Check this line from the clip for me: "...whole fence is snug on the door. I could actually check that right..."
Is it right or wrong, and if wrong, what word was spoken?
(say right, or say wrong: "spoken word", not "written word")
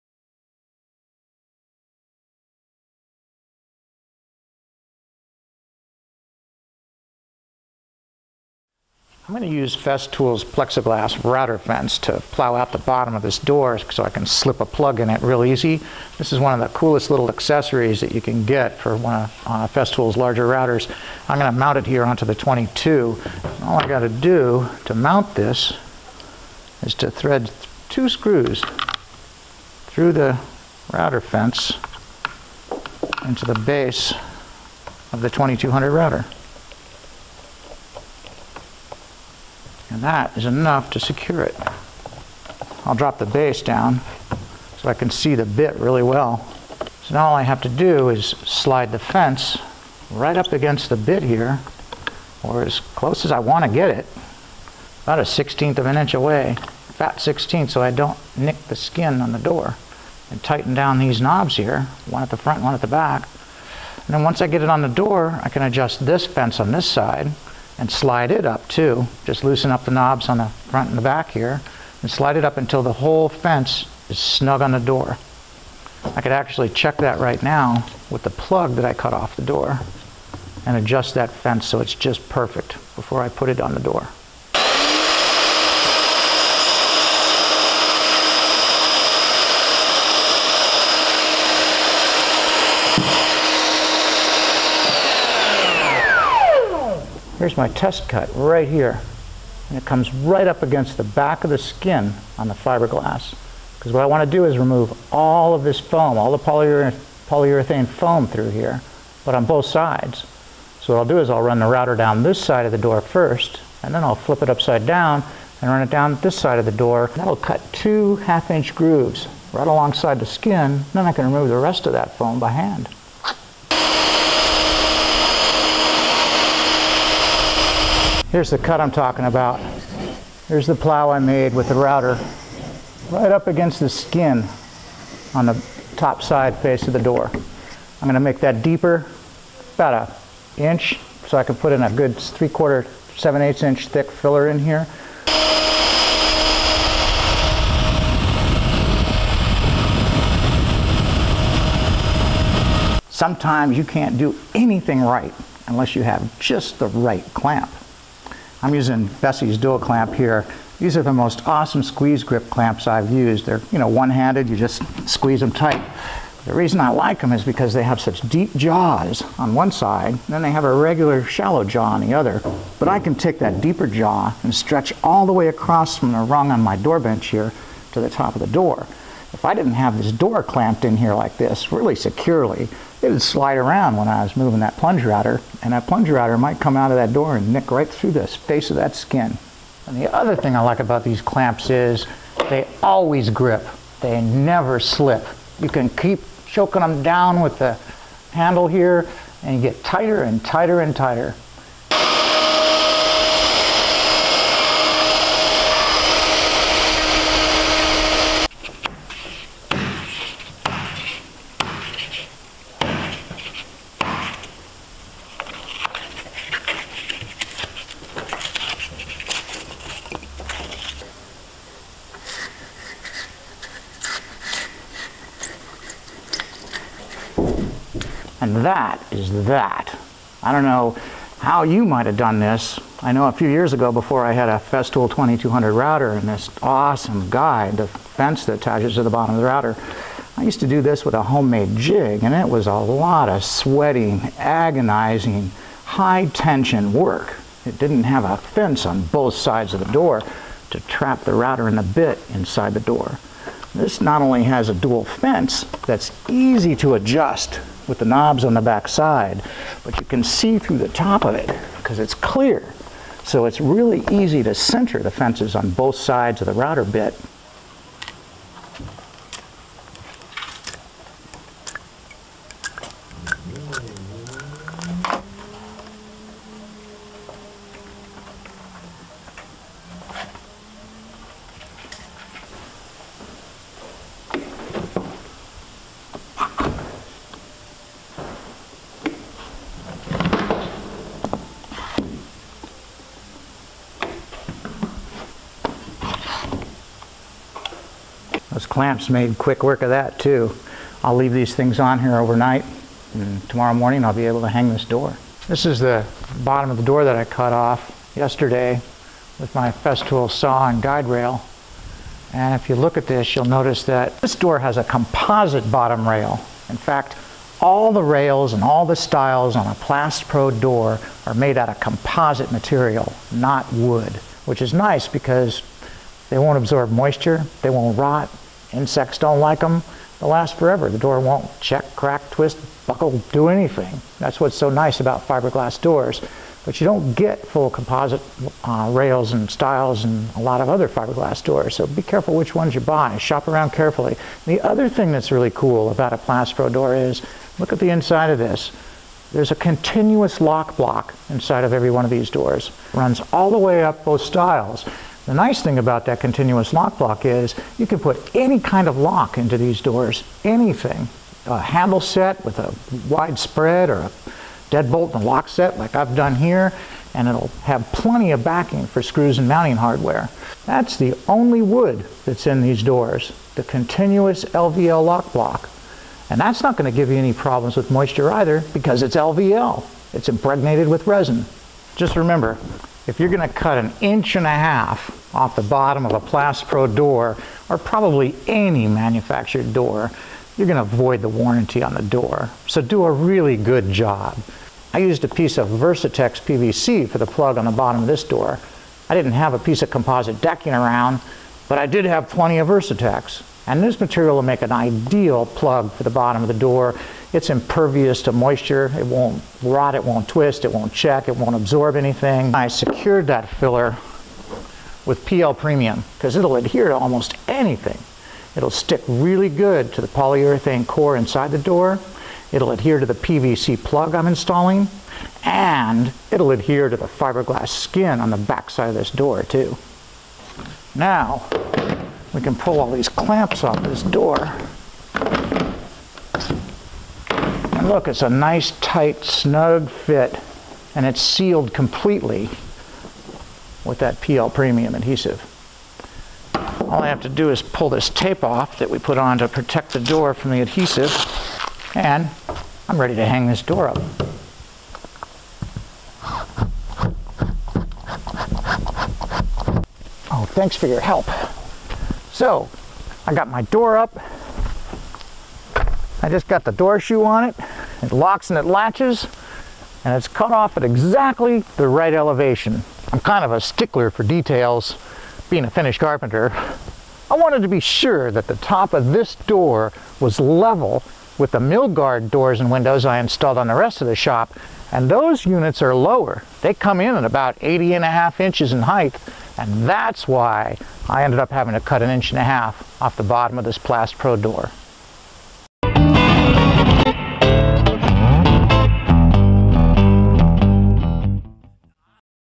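right.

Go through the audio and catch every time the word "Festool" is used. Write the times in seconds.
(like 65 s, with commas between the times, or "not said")
9 s, 19 s, 234 s, 309 s.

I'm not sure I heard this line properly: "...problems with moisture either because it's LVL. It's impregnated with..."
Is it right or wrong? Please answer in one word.
right.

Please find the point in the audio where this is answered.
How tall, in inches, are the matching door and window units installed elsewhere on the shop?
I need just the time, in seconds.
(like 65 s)
487 s.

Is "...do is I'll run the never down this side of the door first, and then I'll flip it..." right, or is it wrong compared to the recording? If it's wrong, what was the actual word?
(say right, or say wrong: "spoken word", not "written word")
wrong: "router", not "never".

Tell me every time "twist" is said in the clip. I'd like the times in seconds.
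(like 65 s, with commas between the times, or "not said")
332 s, 410 s.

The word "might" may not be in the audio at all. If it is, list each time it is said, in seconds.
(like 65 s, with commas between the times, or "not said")
186 s, 231 s.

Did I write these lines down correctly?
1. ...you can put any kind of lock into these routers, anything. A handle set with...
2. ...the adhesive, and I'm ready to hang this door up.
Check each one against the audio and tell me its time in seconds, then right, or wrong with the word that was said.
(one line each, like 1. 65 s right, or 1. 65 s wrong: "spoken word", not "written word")
1. 357 s wrong: "doors", not "routers"
2. 450 s right.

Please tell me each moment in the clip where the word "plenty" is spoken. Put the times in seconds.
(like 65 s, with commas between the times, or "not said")
367 s, 402 s.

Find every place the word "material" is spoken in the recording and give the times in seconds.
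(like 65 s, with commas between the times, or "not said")
322 s, 403 s.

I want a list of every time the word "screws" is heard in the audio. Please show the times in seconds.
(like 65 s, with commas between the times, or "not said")
28 s, 369 s.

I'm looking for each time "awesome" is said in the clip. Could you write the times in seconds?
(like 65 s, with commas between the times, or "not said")
161 s, 236 s.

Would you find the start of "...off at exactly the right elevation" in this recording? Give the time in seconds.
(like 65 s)
470 s.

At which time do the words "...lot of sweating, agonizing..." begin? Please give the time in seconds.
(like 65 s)
242 s.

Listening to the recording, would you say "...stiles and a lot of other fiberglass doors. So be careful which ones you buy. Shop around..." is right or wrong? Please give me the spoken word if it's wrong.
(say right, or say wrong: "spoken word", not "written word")
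right.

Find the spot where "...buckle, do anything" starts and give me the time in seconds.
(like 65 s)
332 s.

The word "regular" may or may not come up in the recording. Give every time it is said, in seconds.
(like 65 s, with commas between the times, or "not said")
170 s.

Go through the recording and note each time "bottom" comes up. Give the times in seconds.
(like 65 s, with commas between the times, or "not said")
12 s, 239 s, 306 s, 315 s, 385 s, 397 s, 406 s, 493 s.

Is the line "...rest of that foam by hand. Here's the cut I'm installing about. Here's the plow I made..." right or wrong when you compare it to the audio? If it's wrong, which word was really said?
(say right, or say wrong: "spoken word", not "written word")
wrong: "talking", not "installing".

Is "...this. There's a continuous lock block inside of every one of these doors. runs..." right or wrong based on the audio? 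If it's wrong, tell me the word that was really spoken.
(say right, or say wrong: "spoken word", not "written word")
right.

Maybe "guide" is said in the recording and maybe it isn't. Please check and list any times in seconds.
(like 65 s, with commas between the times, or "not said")
237 s, 310 s.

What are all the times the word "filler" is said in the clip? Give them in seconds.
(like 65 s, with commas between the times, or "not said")
144 s, 413 s.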